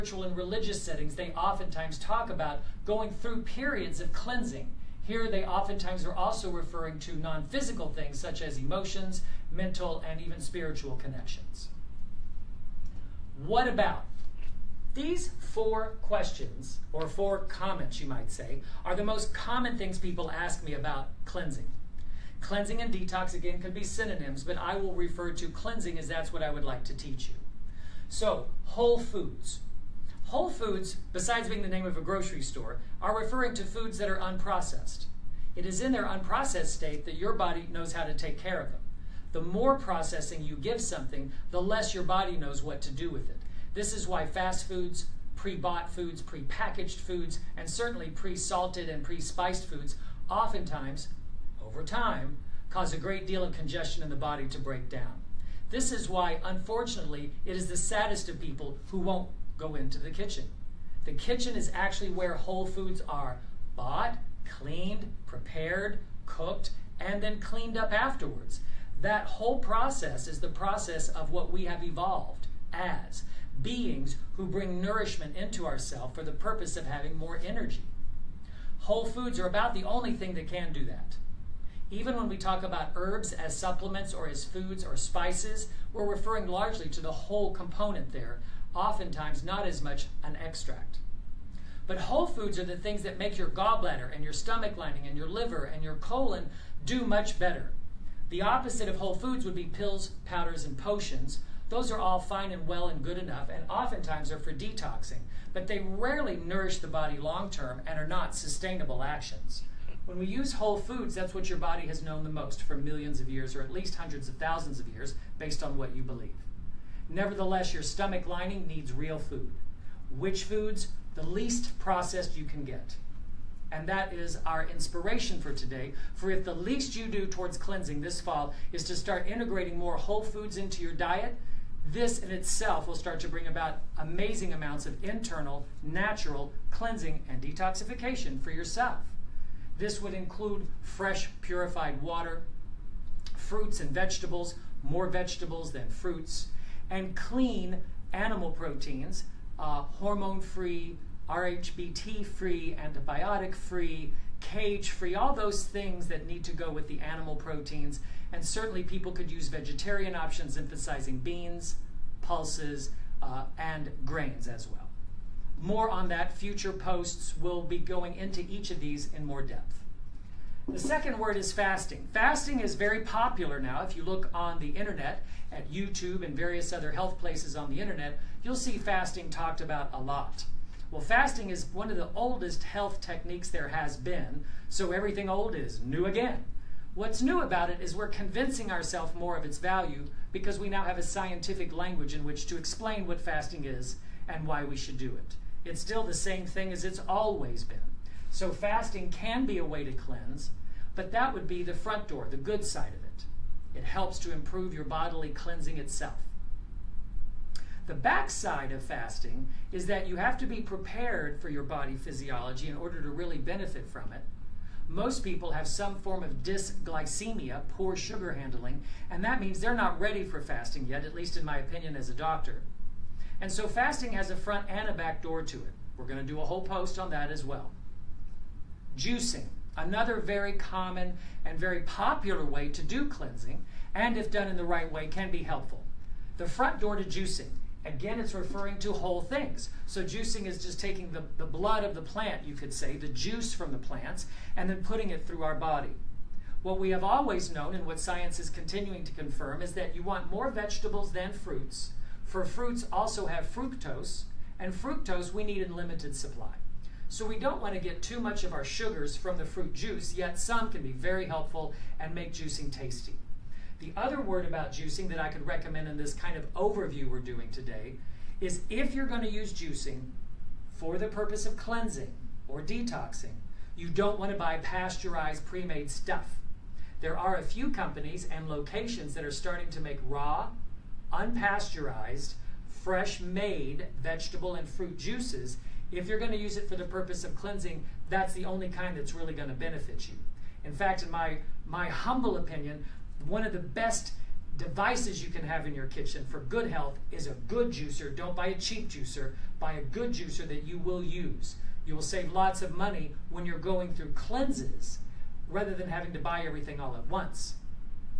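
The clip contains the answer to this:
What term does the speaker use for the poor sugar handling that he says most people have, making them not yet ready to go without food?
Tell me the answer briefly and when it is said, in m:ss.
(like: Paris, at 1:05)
Dysglycemia, at 3:36.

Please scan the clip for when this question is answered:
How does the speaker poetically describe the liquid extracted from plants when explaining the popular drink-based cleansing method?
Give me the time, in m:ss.
4:01.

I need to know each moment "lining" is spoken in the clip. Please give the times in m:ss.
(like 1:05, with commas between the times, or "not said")
1:34, 1:58.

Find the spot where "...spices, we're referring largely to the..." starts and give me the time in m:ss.
1:24.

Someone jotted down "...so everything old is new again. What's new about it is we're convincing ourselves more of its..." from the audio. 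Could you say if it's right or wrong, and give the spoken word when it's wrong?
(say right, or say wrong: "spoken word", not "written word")
right.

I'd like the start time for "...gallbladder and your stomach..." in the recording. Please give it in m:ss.
1:33.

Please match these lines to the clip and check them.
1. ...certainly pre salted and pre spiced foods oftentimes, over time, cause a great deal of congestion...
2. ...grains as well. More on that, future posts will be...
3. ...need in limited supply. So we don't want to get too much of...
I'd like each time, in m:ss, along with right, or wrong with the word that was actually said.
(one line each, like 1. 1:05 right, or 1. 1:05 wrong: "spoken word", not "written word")
1. 0:47 right
2. 2:44 right
3. 4:15 right.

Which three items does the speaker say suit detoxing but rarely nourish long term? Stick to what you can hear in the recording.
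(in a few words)
Pills, powders, and potions.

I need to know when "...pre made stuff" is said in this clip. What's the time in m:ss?
4:35.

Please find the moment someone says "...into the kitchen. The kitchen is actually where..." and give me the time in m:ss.
0:59.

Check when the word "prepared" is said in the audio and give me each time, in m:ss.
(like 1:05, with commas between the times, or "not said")
1:05, 3:30.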